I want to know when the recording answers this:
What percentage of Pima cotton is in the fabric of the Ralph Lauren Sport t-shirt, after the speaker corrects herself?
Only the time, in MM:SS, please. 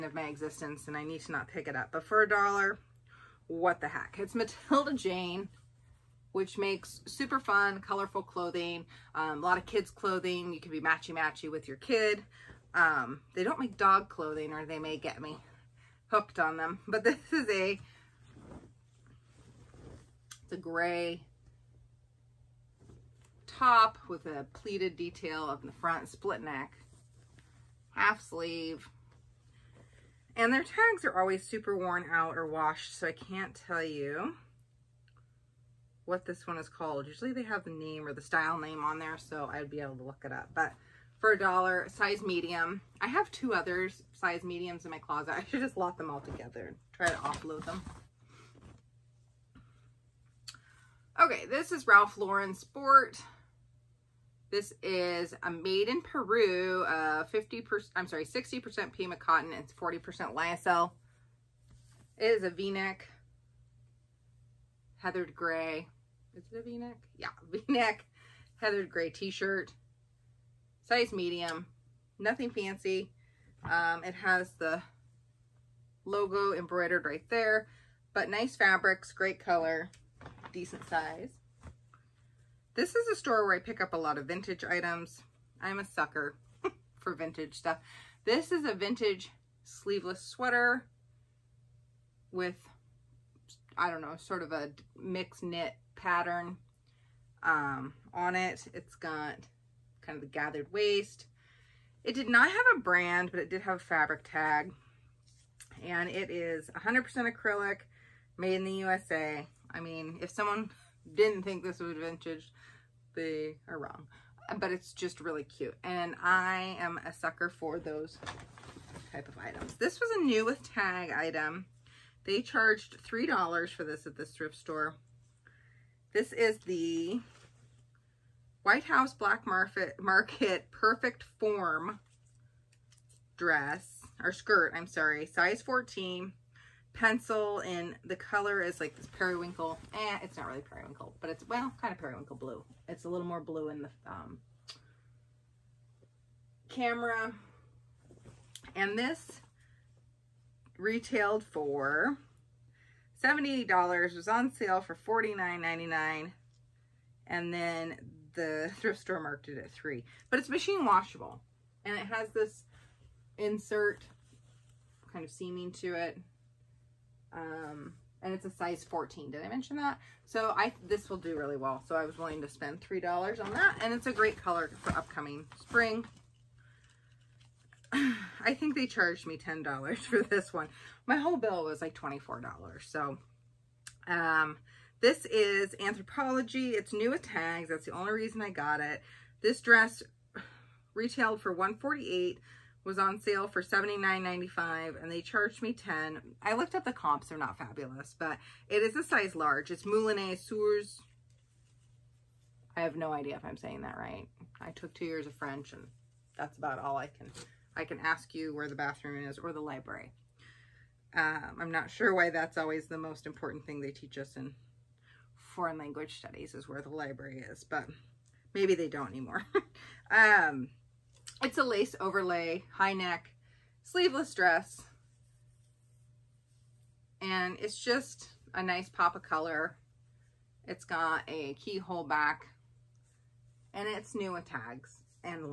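00:58.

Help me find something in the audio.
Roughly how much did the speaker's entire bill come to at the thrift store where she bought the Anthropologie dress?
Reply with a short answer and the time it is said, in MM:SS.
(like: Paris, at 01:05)
$24, at 03:01.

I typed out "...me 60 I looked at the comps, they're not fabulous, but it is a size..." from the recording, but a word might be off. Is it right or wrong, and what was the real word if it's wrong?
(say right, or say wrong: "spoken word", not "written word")
wrong: "10", not "60".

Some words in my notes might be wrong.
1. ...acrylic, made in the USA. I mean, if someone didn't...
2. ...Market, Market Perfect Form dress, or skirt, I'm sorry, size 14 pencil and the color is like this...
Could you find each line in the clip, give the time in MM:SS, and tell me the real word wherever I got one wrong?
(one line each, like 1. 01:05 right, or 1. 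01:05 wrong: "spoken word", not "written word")
1. 01:47 right
2. 02:09 right.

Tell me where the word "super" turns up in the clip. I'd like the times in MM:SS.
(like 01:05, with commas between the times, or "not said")
00:07, 00:31.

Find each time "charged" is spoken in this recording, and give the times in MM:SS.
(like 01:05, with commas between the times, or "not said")
02:02, 02:58, 03:15.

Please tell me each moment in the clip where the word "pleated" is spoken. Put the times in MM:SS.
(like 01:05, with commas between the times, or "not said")
00:24.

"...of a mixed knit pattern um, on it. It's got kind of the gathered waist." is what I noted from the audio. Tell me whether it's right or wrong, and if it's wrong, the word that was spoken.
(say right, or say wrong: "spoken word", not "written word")
right.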